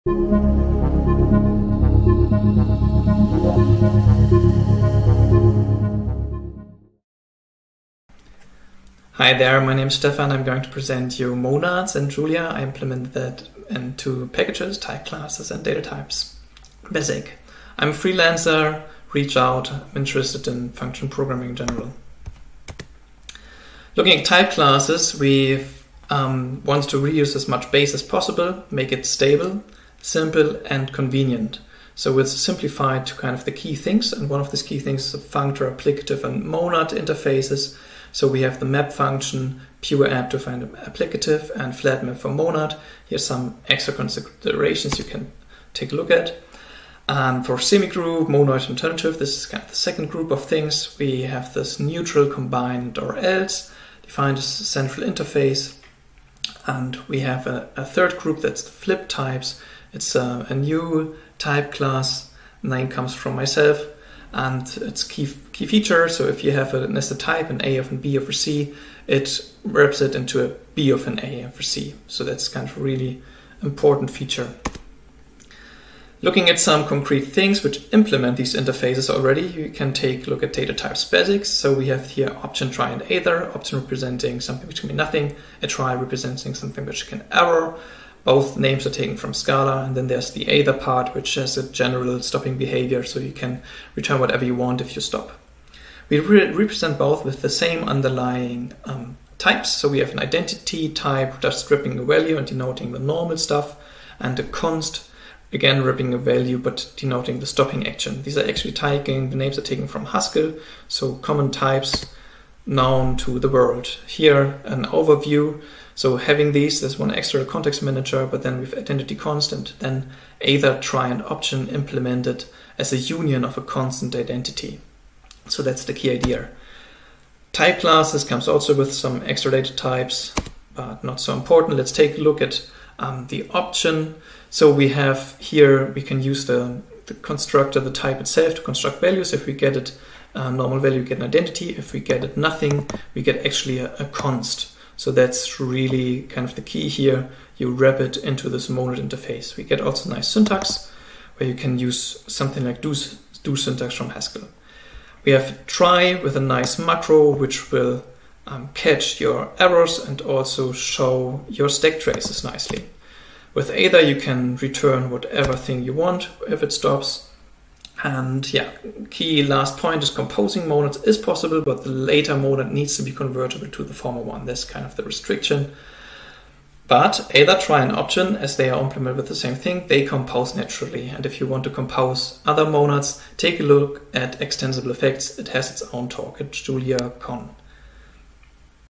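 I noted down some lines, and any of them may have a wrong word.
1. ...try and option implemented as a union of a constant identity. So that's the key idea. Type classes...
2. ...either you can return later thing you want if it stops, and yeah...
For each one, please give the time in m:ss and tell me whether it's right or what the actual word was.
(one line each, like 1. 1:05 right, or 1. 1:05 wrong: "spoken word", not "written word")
1. 2:00 right
2. 2:43 wrong: "whatever", not "later".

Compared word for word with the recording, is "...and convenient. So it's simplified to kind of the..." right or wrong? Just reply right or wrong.
right.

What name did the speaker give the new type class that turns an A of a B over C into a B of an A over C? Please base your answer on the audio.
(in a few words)
flip types.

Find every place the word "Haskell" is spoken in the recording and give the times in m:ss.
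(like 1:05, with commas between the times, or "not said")
1:50, 2:34.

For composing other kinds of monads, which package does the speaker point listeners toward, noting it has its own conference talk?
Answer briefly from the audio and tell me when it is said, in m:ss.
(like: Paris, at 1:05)
Extensible Effects, at 3:04.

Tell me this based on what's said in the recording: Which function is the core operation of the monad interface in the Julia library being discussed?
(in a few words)
flat map.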